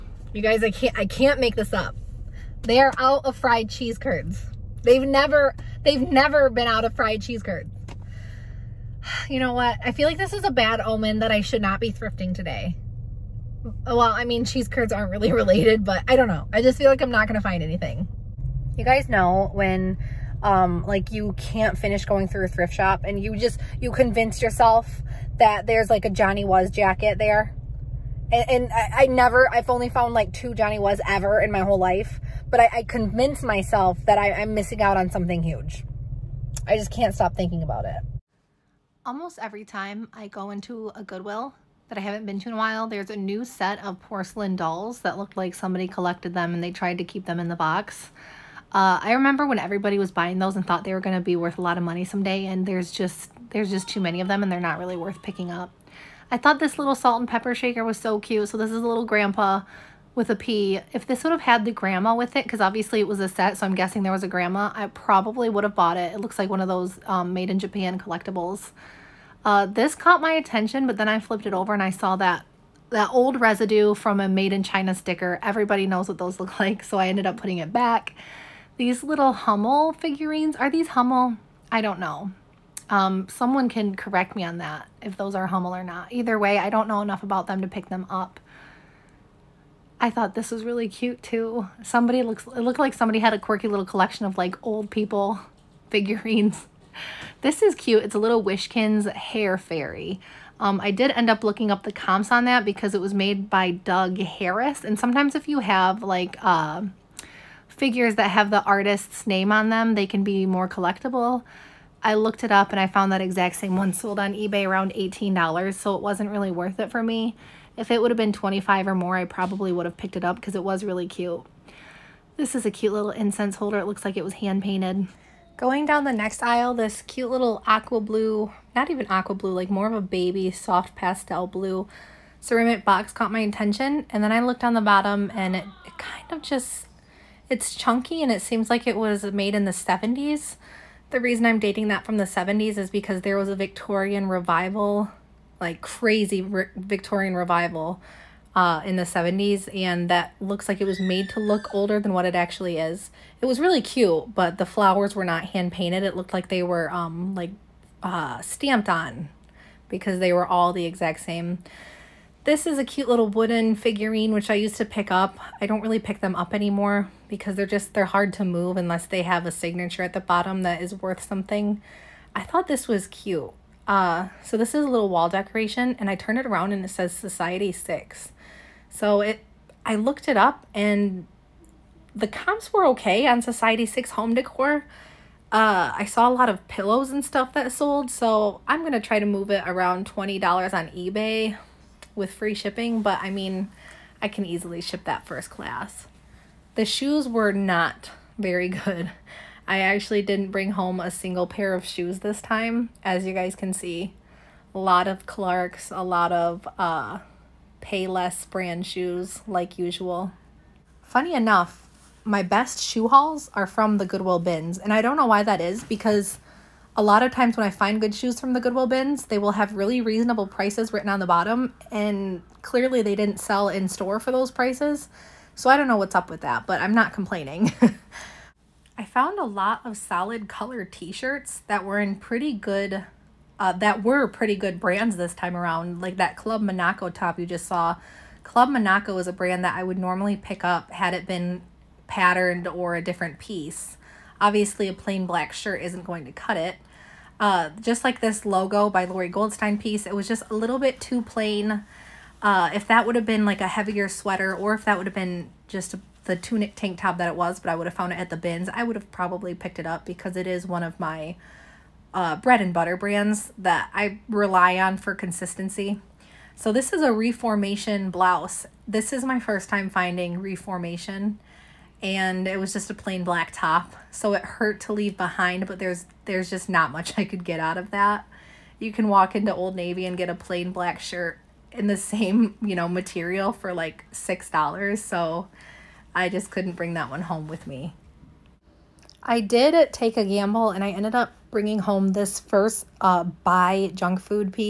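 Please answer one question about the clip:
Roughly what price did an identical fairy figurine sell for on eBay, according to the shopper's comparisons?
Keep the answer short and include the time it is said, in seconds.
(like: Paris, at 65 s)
$18, at 114 s.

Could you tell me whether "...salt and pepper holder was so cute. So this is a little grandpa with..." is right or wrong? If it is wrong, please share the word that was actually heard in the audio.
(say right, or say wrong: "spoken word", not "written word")
wrong: "shaker", not "holder".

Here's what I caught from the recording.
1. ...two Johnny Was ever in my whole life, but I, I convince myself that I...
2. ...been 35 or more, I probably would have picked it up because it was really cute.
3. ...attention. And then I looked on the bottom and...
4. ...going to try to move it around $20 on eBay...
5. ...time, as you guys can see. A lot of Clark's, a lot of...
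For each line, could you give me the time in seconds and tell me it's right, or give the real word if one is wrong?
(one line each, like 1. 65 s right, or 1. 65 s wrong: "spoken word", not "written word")
1. 30 s right
2. 118 s wrong: "25", not "35"
3. 133 s right
4. 188 s right
5. 202 s right.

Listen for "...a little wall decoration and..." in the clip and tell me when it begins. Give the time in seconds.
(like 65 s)
174 s.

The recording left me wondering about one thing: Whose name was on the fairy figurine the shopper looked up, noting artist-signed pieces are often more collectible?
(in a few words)
Doug Harris.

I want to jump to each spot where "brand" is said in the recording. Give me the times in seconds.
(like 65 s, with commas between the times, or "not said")
208 s, 234 s, 239 s, 262 s.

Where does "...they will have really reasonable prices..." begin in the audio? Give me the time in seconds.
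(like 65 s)
219 s.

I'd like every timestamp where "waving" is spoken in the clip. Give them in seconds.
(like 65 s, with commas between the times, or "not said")
not said.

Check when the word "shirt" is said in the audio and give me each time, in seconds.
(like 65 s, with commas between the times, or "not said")
230 s, 245 s, 280 s.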